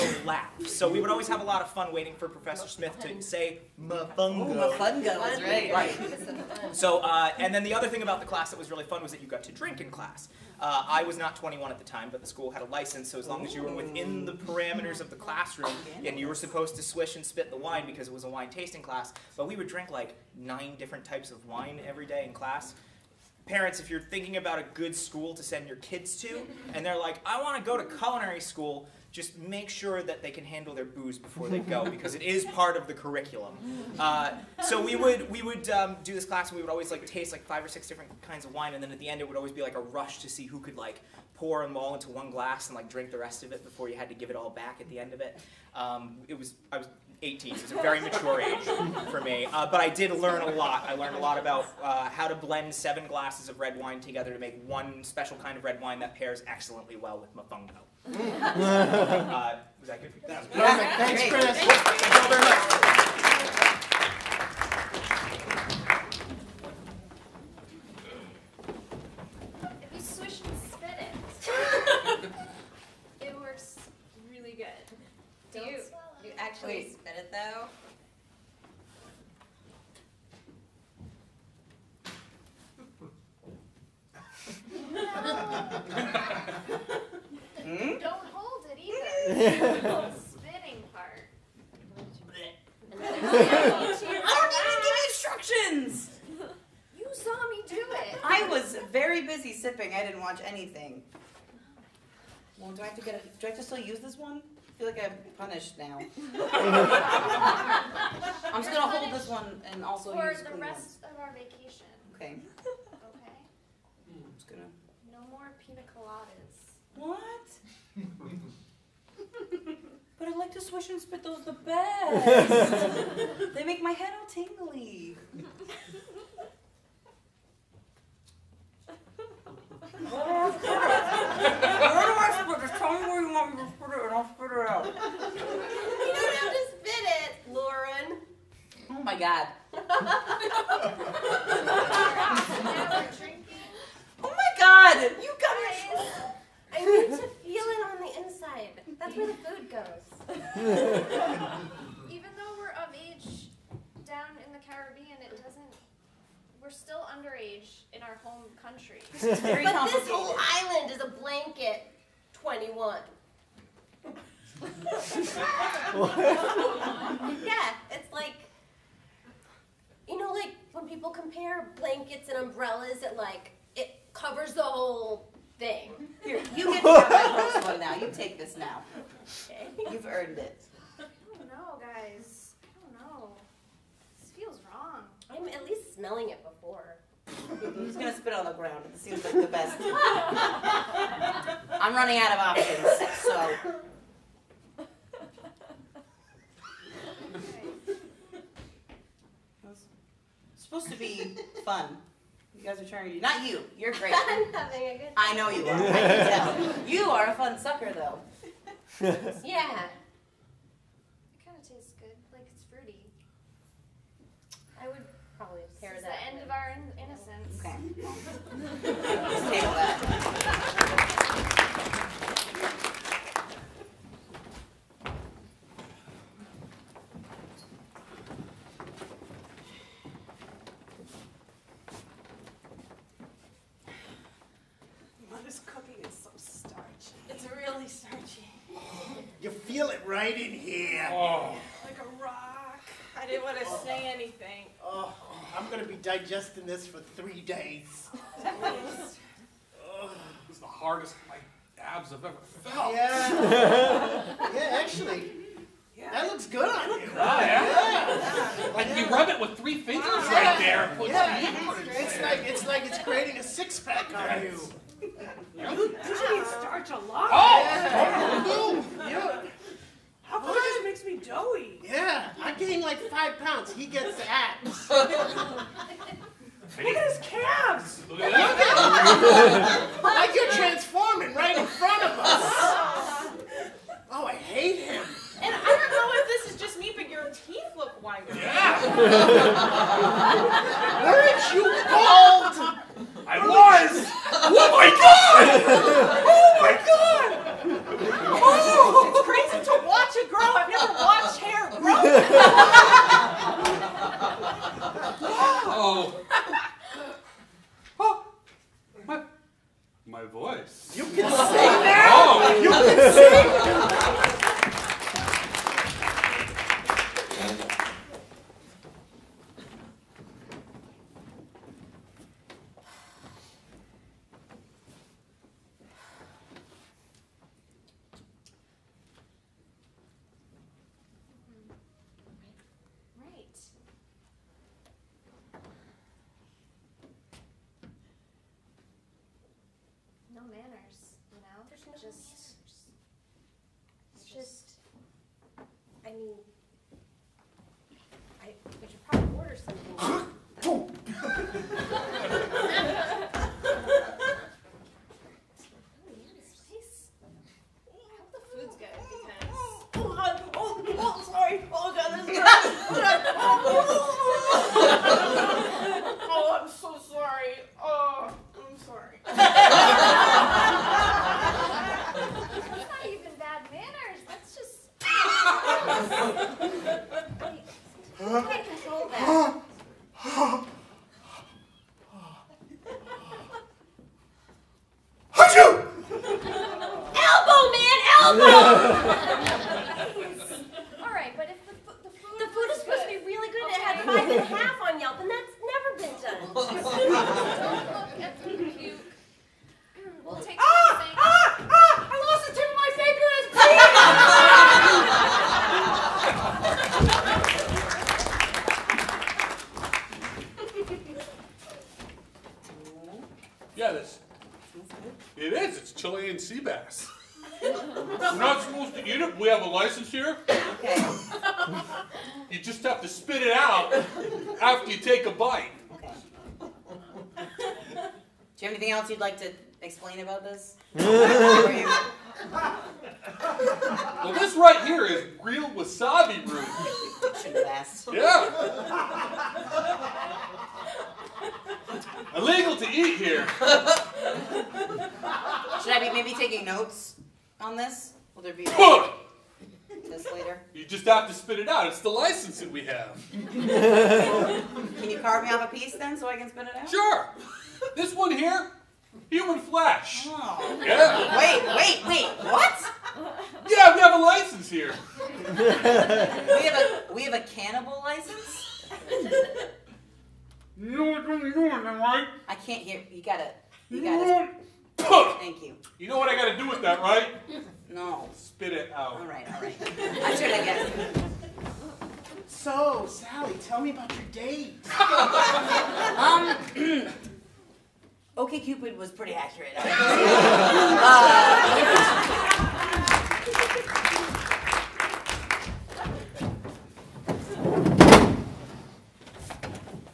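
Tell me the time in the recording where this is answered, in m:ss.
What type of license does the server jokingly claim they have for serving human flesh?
7:47.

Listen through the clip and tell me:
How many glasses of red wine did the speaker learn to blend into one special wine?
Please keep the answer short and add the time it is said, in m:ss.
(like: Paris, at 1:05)
7, at 0:52.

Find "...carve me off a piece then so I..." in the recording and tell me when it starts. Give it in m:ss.
7:35.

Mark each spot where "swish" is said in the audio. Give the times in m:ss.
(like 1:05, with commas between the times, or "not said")
0:16, 2:00.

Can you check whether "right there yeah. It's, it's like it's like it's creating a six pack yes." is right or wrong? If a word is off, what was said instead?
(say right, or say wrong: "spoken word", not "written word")
right.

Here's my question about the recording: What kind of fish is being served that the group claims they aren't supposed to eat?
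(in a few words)
Chilean sea bass.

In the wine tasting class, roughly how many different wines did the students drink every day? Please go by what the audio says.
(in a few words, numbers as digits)
9.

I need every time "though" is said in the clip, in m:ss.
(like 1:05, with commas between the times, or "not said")
1:17, 2:32, 3:27.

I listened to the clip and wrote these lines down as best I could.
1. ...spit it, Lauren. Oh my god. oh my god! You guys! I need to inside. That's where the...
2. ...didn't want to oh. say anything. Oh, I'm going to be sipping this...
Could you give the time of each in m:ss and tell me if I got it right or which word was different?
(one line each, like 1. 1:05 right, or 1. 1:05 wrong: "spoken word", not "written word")
1. 2:16 right
2. 4:03 wrong: "digesting", not "sipping".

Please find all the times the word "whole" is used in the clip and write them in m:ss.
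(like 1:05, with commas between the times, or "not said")
2:40, 2:54.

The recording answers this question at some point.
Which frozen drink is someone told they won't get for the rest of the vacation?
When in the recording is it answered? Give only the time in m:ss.
1:55.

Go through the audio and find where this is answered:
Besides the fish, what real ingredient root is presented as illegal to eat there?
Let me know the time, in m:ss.
7:15.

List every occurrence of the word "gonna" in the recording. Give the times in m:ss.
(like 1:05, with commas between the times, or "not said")
1:48, 1:54, 3:07.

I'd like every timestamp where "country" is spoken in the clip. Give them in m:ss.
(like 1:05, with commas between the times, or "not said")
2:38.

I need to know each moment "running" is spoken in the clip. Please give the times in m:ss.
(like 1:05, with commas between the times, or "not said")
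3:11.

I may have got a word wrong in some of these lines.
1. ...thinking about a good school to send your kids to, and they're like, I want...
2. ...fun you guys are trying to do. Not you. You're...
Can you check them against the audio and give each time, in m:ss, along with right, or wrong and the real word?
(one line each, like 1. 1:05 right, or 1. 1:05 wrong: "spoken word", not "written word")
1. 0:23 right
2. 3:21 right.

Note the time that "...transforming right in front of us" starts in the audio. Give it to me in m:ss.
4:40.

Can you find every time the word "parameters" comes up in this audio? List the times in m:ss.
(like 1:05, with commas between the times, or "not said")
0:14.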